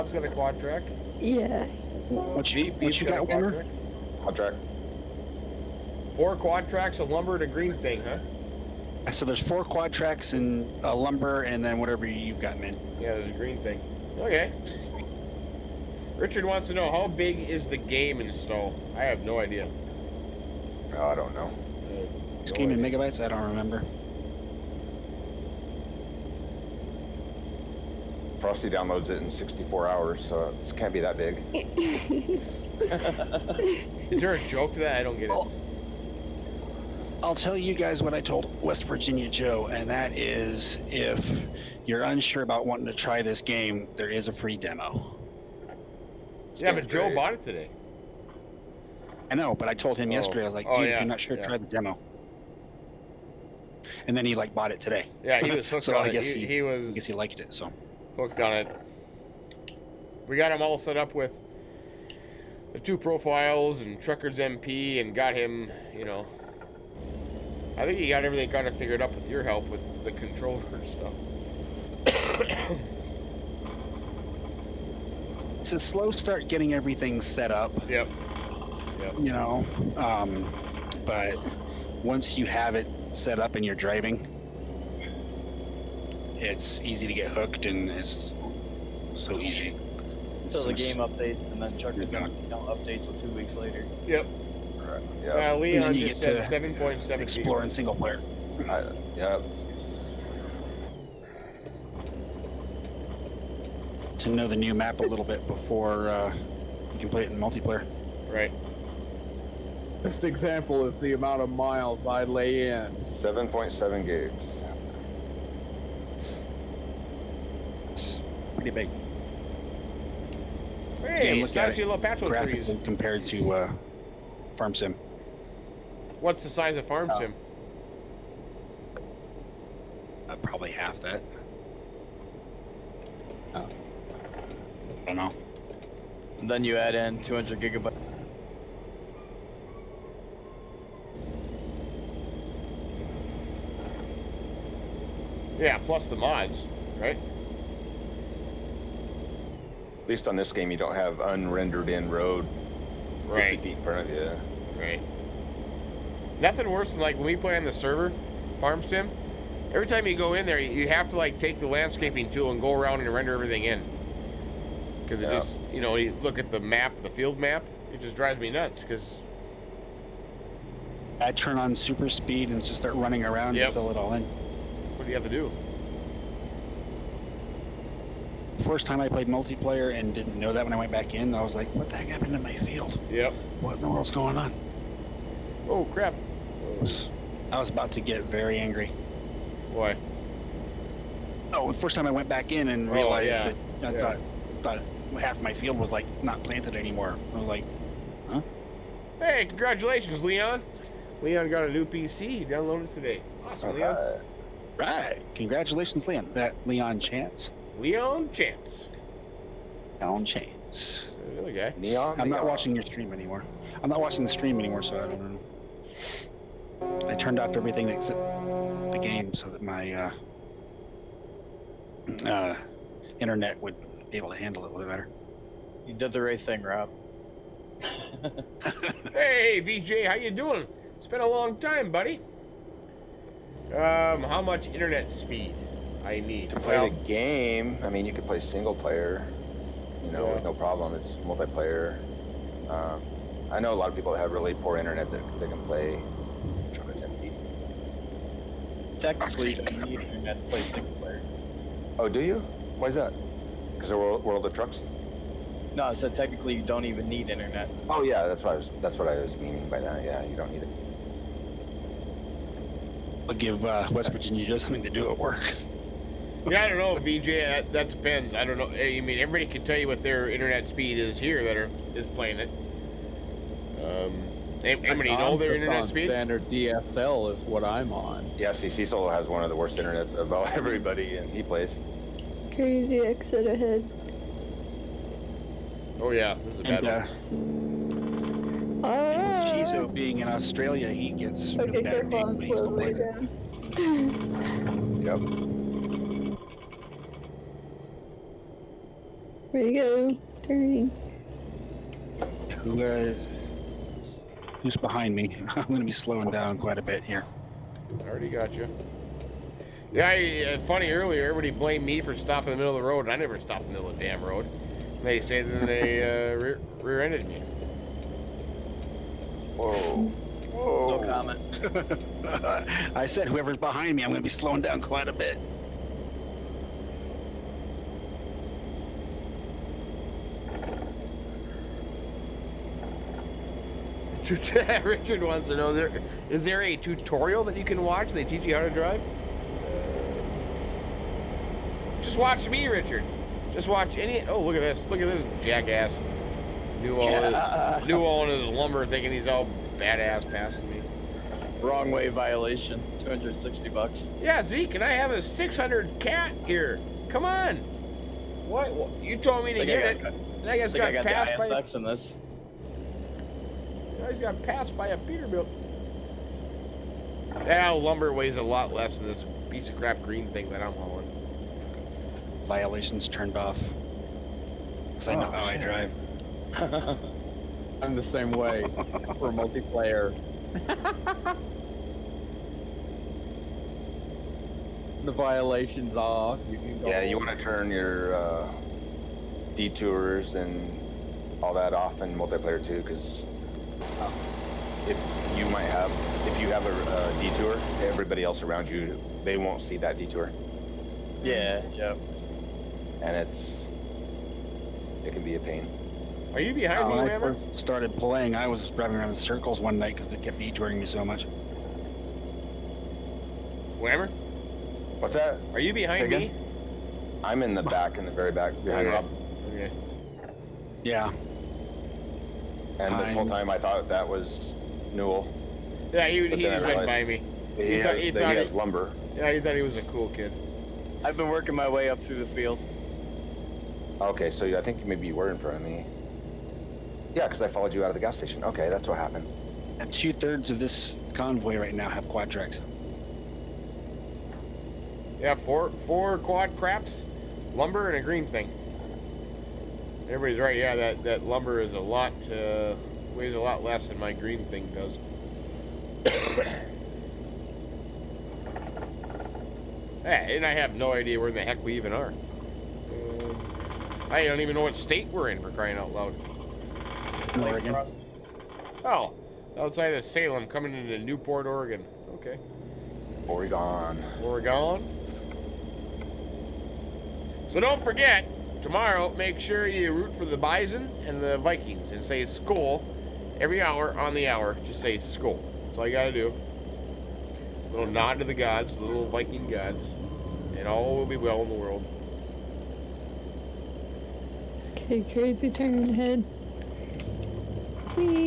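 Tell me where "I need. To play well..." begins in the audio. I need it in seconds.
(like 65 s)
236 s.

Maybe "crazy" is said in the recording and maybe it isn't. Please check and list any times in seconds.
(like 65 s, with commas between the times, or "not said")
282 s, 495 s.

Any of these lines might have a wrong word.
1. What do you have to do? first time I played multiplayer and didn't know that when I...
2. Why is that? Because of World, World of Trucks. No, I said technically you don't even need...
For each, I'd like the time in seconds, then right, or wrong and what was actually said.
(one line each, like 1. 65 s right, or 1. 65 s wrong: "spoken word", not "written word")
1. 174 s right
2. 252 s right.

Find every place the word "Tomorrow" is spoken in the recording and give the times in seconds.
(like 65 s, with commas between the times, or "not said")
478 s.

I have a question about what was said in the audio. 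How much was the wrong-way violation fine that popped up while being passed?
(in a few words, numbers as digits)
$260.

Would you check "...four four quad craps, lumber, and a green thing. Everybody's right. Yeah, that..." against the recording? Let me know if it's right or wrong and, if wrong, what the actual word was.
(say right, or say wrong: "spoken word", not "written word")
right.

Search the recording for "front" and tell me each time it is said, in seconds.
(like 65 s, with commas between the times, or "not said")
153 s, 435 s.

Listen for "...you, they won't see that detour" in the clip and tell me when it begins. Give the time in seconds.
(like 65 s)
398 s.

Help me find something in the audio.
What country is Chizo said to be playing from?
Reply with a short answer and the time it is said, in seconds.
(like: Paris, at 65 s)
Australia, at 290 s.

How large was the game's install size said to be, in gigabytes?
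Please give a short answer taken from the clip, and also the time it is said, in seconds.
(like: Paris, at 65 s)
7.7 gigs, at 113 s.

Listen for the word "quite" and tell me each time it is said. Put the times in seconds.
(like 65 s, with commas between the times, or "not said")
306 s, 324 s.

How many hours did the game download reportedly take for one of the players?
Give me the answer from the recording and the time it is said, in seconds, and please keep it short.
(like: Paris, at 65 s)
64, at 29 s.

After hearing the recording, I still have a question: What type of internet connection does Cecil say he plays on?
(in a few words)
Standard DSL.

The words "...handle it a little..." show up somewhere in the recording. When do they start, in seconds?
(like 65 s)
224 s.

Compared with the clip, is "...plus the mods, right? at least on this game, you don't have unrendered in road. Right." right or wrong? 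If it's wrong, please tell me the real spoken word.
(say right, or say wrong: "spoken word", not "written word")
right.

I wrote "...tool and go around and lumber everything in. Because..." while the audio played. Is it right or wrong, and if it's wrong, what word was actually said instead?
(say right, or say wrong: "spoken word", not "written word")
wrong: "render", not "lumber".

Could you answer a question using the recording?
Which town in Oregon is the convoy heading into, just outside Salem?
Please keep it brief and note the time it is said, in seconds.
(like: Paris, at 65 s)
Newport, at 470 s.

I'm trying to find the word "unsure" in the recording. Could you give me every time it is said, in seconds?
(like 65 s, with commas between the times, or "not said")
42 s.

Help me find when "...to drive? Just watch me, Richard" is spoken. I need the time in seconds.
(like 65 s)
338 s.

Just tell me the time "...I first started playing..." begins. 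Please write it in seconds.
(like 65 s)
407 s.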